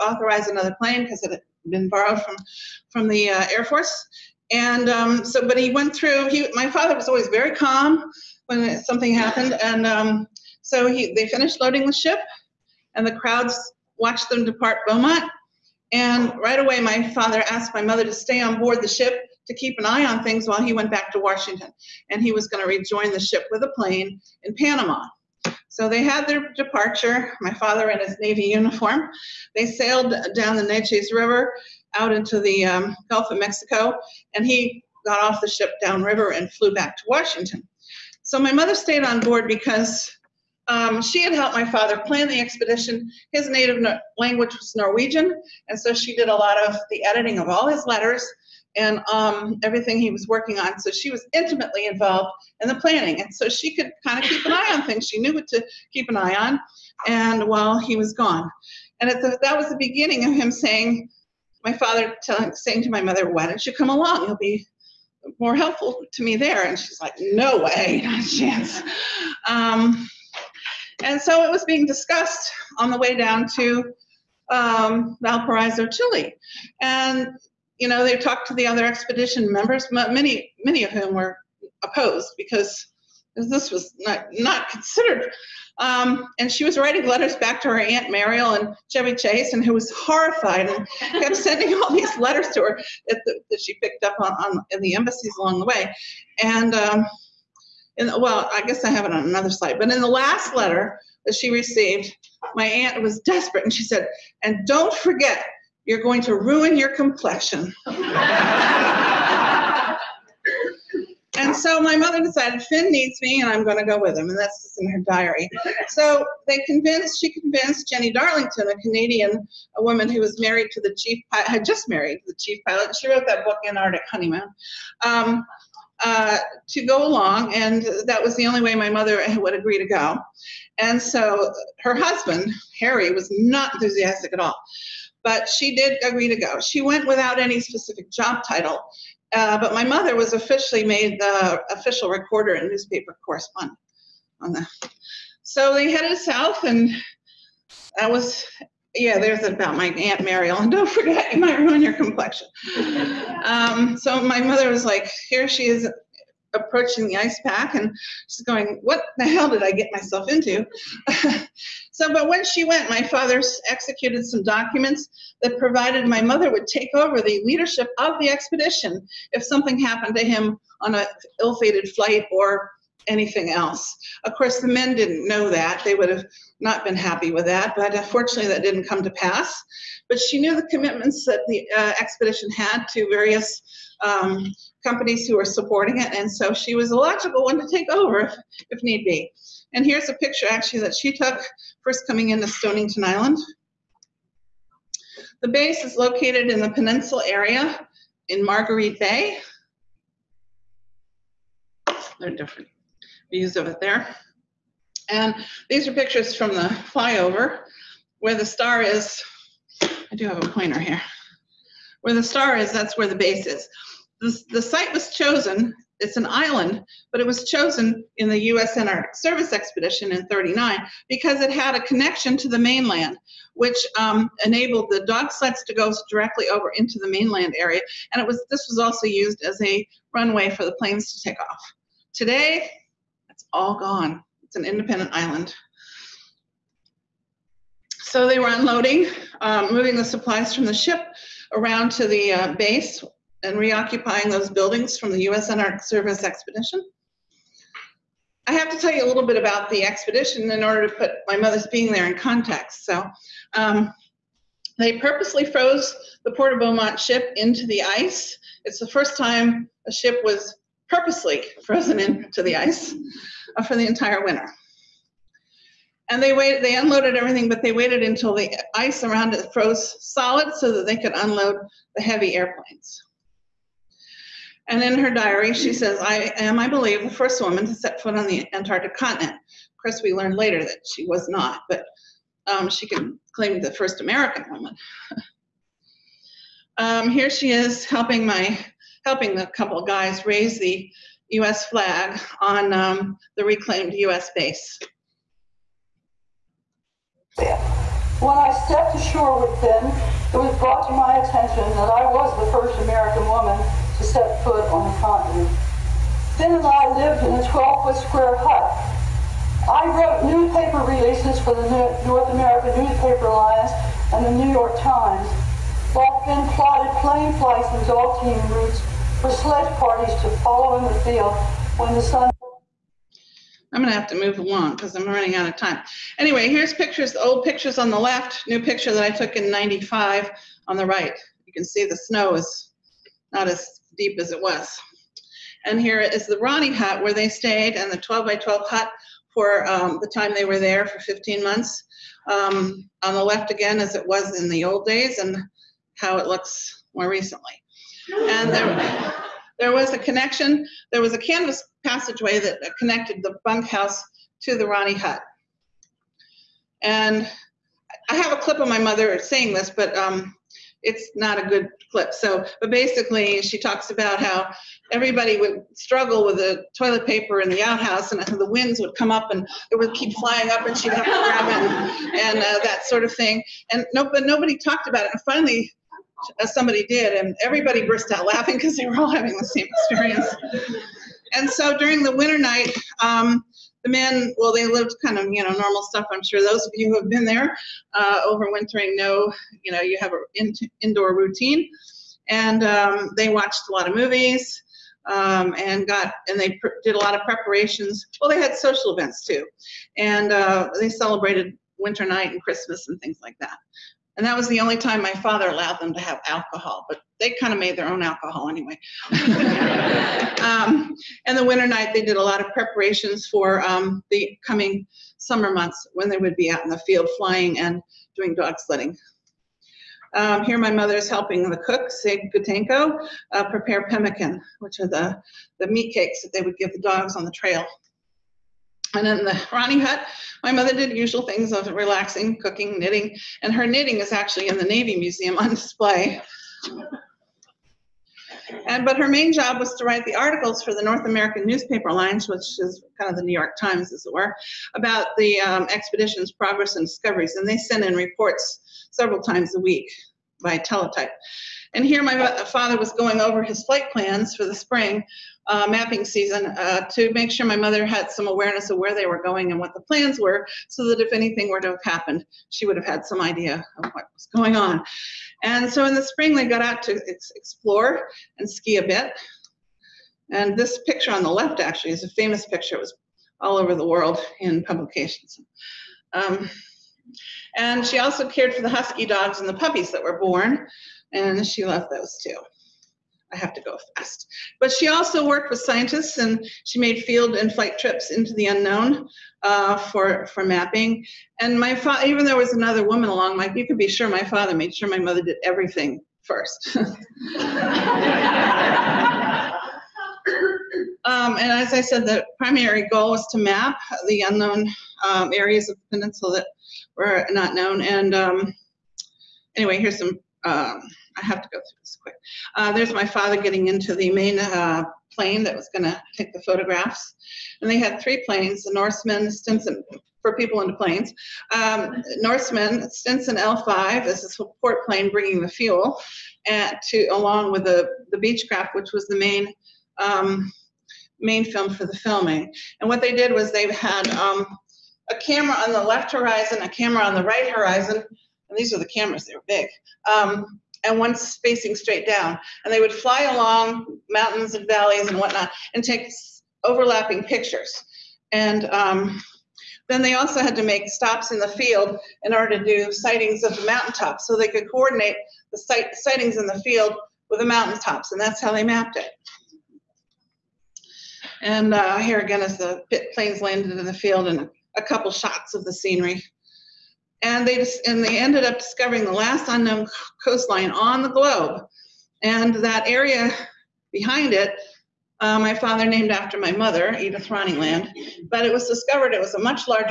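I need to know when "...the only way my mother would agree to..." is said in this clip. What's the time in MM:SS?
02:08.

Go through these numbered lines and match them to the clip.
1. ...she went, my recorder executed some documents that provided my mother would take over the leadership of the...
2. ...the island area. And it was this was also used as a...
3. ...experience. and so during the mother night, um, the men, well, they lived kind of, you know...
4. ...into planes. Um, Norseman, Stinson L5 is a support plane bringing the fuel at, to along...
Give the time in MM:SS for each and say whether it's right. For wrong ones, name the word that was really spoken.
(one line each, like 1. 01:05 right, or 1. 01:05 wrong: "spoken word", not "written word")
1. 02:42 wrong: "father", not "recorder"
2. 03:46 wrong: "mainland", not "island"
3. 06:19 wrong: "winter", not "mother"
4. 08:40 right.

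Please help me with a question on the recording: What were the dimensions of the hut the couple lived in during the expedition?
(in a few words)
12-foot square.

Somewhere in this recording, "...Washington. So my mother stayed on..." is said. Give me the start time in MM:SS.
00:37.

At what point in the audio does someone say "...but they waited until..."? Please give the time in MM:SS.
04:27.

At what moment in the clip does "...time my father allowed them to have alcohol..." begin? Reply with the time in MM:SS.
06:44.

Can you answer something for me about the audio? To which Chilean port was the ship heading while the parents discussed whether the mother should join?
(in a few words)
Valparaiso.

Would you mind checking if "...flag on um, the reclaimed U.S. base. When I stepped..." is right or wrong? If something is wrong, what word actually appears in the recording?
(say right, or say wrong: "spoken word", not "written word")
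right.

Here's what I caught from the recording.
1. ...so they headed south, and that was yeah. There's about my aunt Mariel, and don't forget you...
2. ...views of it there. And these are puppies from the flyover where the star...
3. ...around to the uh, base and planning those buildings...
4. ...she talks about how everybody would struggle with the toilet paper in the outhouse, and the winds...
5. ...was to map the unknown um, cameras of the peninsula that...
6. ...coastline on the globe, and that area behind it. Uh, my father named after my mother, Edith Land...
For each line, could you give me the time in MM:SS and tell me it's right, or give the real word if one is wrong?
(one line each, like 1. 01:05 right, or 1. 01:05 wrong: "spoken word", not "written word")
1. 02:25 right
2. 03:23 wrong: "pictures", not "puppies"
3. 04:01 wrong: "reoccupying", not "planning"
4. 06:03 right
5. 08:23 wrong: "areas", not "cameras"
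6. 09:30 right.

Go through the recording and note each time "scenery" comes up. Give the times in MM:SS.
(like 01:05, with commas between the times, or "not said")
09:25.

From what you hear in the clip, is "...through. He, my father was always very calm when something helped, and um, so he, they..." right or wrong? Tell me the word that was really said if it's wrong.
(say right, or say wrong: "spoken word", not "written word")
wrong: "happened", not "helped".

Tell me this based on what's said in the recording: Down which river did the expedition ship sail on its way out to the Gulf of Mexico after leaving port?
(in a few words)
Neches River.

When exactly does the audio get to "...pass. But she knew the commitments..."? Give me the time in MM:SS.
02:59.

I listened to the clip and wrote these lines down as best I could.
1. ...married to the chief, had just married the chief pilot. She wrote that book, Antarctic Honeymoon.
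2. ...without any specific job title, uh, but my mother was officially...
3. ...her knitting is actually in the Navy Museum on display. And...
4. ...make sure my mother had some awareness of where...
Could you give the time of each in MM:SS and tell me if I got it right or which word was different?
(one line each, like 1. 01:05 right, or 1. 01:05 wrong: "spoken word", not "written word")
1. 02:00 right
2. 02:17 right
3. 07:13 right
4. 07:37 right.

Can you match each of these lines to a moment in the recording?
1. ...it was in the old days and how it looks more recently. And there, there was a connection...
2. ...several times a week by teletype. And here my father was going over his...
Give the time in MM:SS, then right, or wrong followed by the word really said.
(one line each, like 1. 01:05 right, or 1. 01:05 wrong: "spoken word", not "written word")
1. 05:43 right
2. 07:28 right.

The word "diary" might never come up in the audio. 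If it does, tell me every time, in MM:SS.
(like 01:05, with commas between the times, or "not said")
01:55, 04:35.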